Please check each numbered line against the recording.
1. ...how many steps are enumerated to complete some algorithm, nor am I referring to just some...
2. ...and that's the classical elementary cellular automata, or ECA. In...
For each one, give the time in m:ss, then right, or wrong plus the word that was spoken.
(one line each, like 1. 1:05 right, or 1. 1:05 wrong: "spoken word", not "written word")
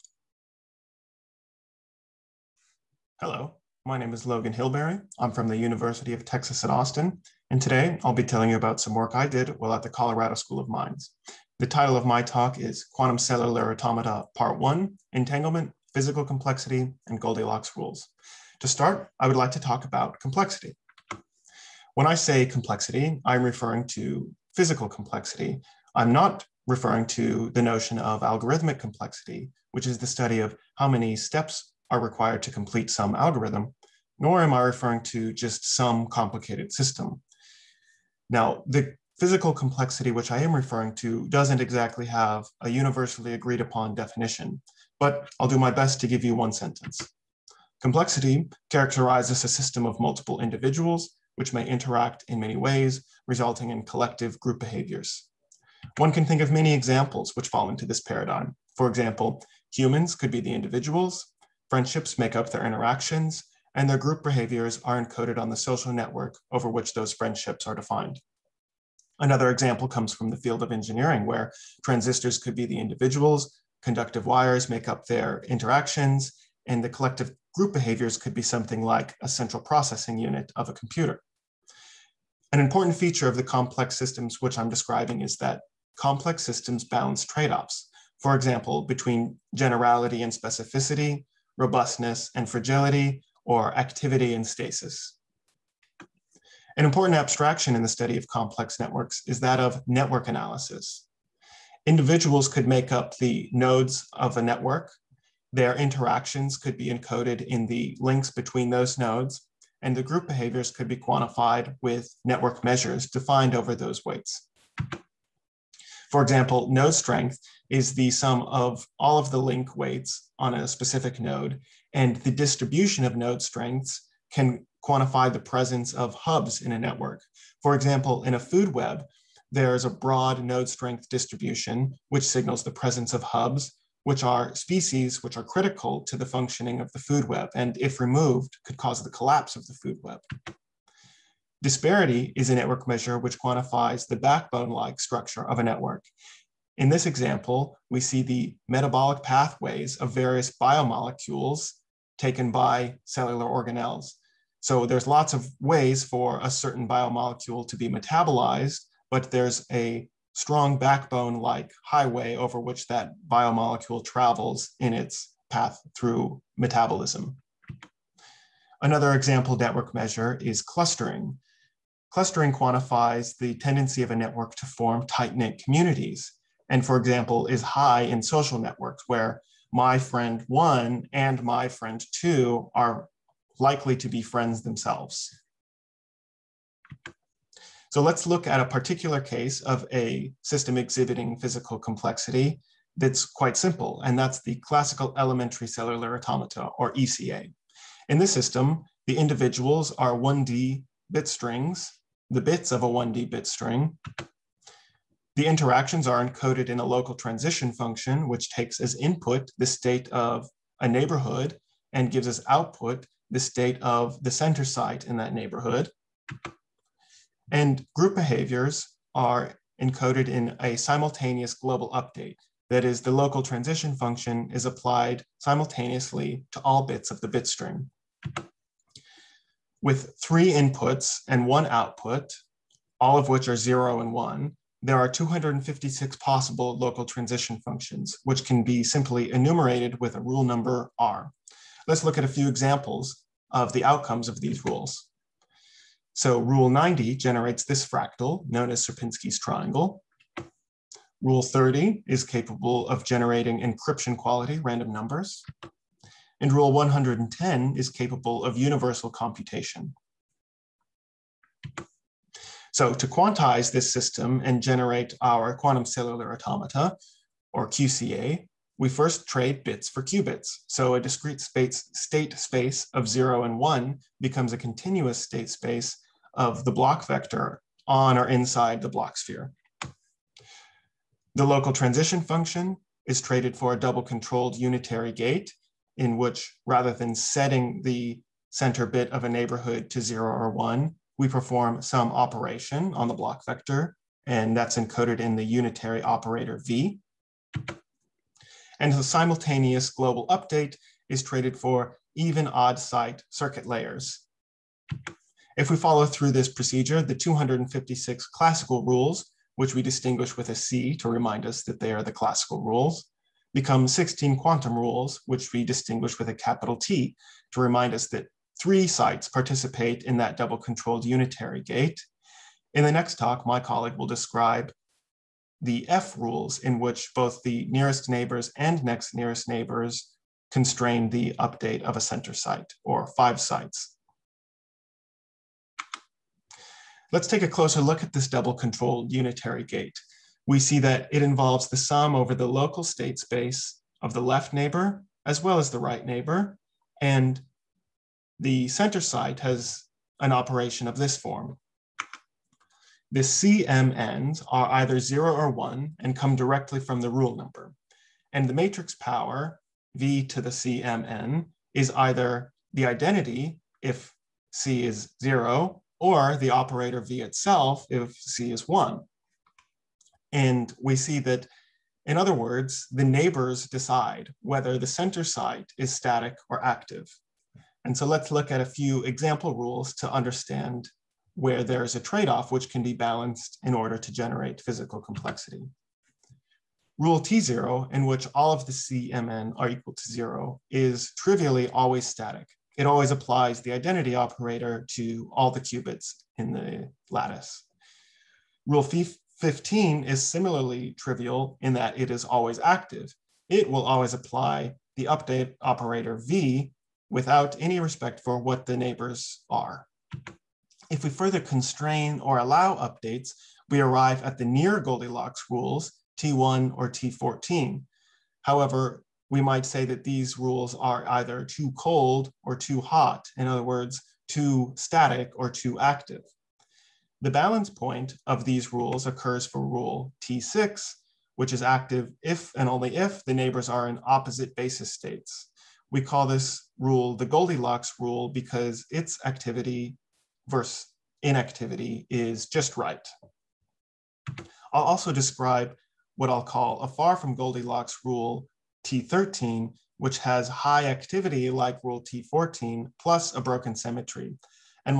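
1. 0:30 wrong: "required", not "enumerated"
2. 3:14 right.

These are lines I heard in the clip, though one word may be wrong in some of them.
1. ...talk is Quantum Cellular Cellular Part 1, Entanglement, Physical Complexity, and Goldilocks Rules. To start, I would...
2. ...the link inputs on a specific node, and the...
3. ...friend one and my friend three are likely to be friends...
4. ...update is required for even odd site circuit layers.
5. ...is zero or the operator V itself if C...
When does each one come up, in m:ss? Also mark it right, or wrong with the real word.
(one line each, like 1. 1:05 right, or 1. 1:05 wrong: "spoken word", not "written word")
1. 0:12 wrong: "Automata", not "Cellular"
2. 1:59 wrong: "weights", not "inputs"
3. 2:59 wrong: "two", not "three"
4. 5:00 wrong: "traded", not "required"
5. 6:04 right.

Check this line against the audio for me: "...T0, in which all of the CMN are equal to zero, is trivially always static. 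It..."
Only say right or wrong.
right.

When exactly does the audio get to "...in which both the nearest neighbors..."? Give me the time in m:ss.
5:26.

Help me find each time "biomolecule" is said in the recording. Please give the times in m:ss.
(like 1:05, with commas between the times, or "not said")
2:30, 2:36, 2:43.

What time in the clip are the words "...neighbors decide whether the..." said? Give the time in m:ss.
6:13.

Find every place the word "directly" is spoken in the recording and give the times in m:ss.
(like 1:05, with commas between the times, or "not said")
5:56.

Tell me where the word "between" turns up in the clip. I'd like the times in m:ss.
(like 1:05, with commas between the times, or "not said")
1:28, 1:48.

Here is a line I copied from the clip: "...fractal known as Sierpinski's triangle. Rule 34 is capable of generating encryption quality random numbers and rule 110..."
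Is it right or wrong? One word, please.
wrong.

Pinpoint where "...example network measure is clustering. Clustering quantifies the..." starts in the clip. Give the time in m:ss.
2:49.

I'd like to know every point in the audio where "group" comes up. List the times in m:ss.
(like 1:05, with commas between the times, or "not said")
0:54, 1:03, 1:17, 1:50, 3:37.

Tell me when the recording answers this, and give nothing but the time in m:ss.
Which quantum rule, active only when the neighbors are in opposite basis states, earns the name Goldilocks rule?
7:10.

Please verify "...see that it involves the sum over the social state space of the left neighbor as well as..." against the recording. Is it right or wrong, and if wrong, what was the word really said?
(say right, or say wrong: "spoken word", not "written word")
wrong: "local", not "social".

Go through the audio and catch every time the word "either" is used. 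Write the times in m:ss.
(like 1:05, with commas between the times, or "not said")
5:54, 6:01, 7:01.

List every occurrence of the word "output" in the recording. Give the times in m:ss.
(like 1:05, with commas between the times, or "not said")
3:32, 3:51.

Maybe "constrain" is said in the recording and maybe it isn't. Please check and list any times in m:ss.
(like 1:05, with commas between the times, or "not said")
5:30, 6:51.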